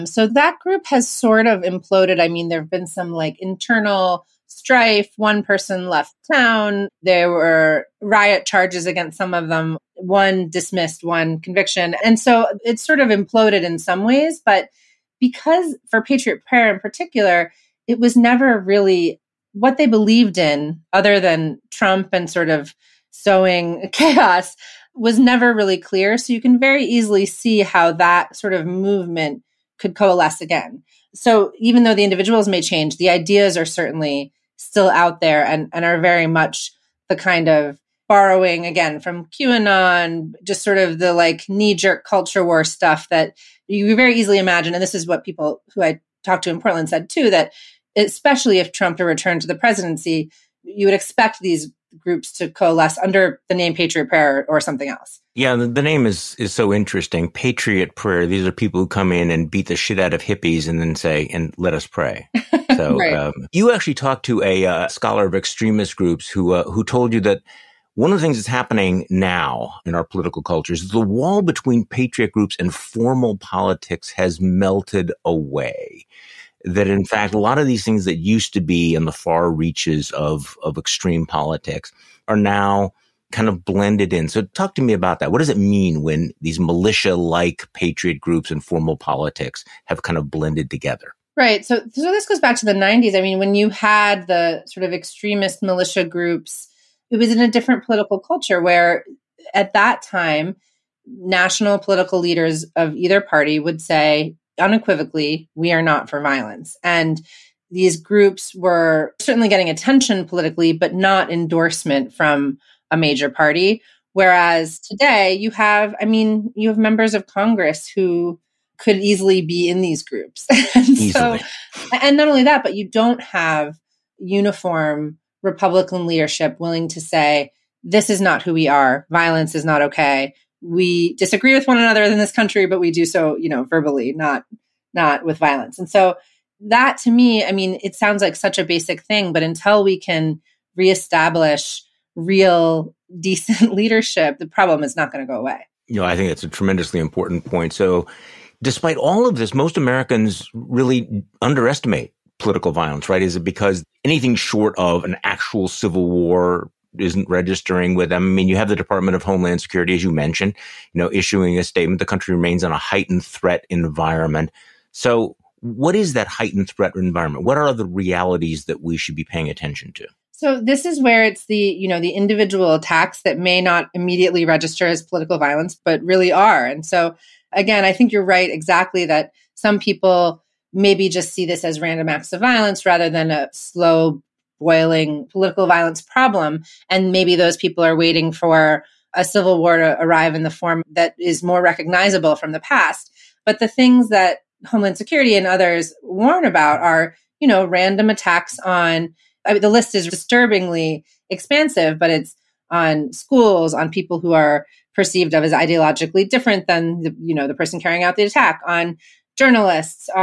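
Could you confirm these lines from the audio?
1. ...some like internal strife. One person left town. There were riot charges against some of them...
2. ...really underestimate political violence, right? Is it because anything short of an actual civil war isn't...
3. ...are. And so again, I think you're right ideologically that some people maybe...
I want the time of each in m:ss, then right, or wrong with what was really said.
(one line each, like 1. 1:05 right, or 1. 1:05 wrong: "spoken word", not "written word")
1. 0:02 right
2. 2:30 right
3. 2:56 wrong: "exactly", not "ideologically".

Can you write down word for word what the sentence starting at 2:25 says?
You know, I think that's a tremendously important point.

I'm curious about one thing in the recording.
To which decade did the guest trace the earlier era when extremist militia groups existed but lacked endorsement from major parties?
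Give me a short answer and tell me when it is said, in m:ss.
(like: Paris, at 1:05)
the 90s, at 1:32.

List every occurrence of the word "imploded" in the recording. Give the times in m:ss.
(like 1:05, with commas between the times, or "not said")
0:01, 0:13.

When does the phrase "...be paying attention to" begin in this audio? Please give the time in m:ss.
2:49.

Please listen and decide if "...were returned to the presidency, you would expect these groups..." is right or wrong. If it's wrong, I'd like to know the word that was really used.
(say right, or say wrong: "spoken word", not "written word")
right.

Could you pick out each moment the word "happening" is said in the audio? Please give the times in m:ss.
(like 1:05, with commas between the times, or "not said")
1:08.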